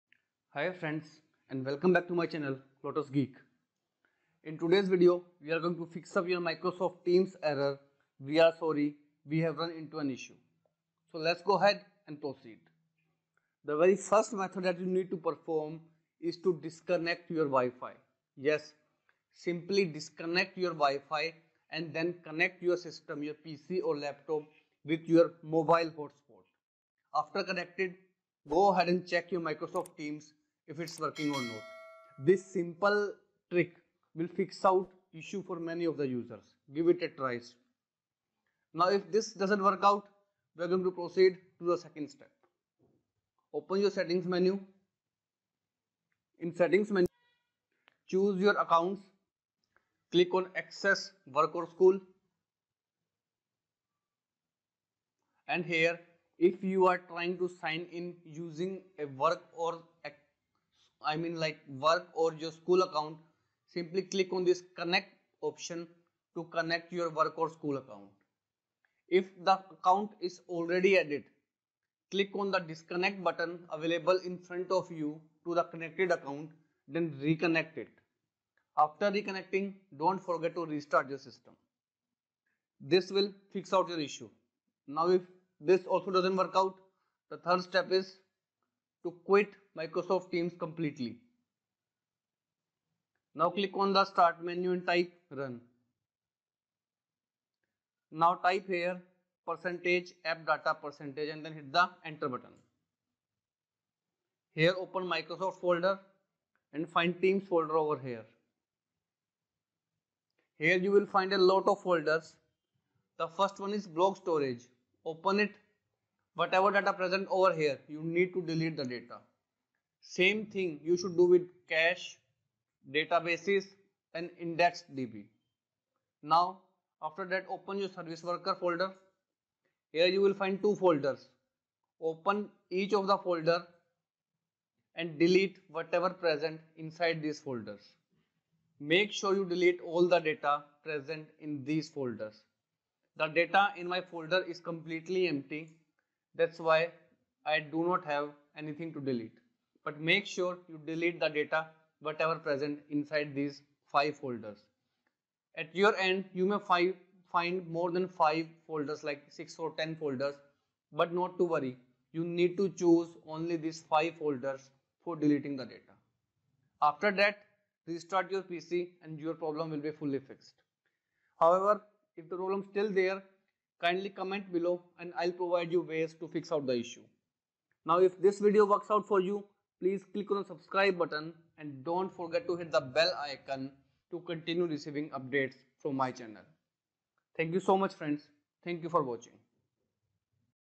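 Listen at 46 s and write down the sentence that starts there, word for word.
In settings menu, choose your accounts.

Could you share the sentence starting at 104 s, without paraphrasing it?
Here open Microsoft folder and find Teams folder over here.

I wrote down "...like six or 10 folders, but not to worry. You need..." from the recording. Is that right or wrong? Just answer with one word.
right.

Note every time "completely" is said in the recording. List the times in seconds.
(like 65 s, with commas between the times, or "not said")
90 s, 144 s.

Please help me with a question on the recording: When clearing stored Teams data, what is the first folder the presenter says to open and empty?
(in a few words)
Blob storage.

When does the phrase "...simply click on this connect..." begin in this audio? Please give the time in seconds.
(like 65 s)
63 s.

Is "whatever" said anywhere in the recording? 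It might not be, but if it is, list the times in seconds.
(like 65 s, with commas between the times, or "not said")
116 s, 135 s, 152 s.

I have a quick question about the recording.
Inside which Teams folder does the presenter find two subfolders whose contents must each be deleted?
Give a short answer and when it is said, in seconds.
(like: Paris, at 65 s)
Service worker, at 127 s.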